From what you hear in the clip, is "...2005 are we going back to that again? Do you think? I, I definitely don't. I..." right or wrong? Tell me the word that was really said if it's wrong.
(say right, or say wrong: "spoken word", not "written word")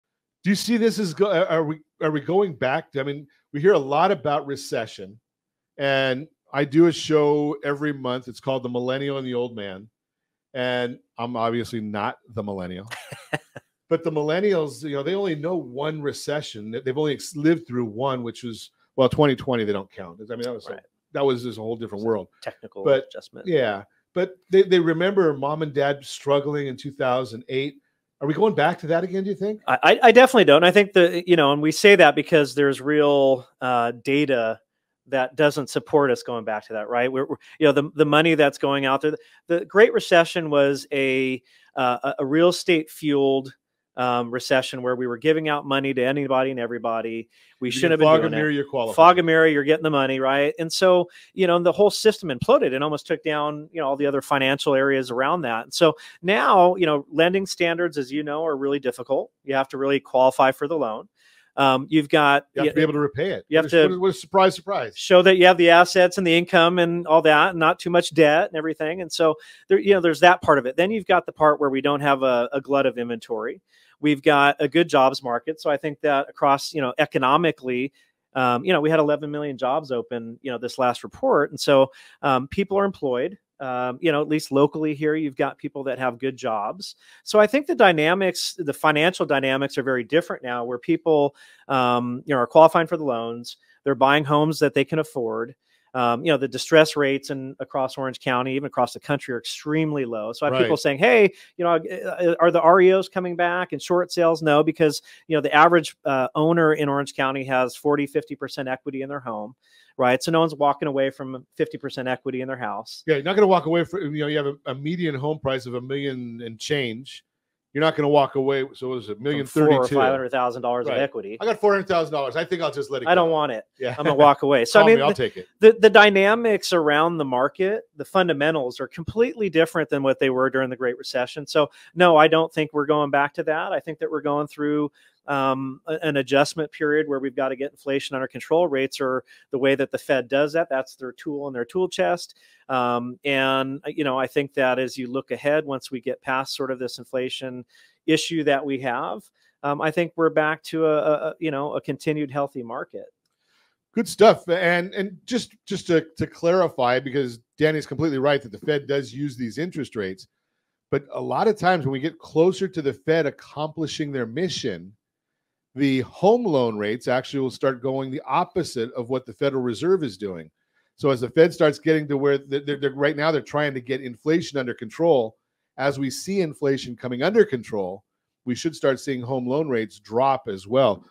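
wrong: "2008", not "2005".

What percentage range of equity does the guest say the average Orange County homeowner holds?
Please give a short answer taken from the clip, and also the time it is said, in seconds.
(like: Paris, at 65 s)
40 to 50 percent, at 107 s.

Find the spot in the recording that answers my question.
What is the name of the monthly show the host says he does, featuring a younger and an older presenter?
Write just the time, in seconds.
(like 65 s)
8 s.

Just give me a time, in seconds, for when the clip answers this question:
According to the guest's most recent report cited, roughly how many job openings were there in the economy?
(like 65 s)
78 s.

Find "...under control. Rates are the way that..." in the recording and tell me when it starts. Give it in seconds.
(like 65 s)
138 s.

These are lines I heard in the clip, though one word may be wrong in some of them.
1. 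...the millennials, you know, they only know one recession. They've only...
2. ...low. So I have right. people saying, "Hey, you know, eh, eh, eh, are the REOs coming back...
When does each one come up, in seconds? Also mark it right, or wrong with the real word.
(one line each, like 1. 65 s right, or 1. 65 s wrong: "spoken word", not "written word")
1. 14 s right
2. 100 s right.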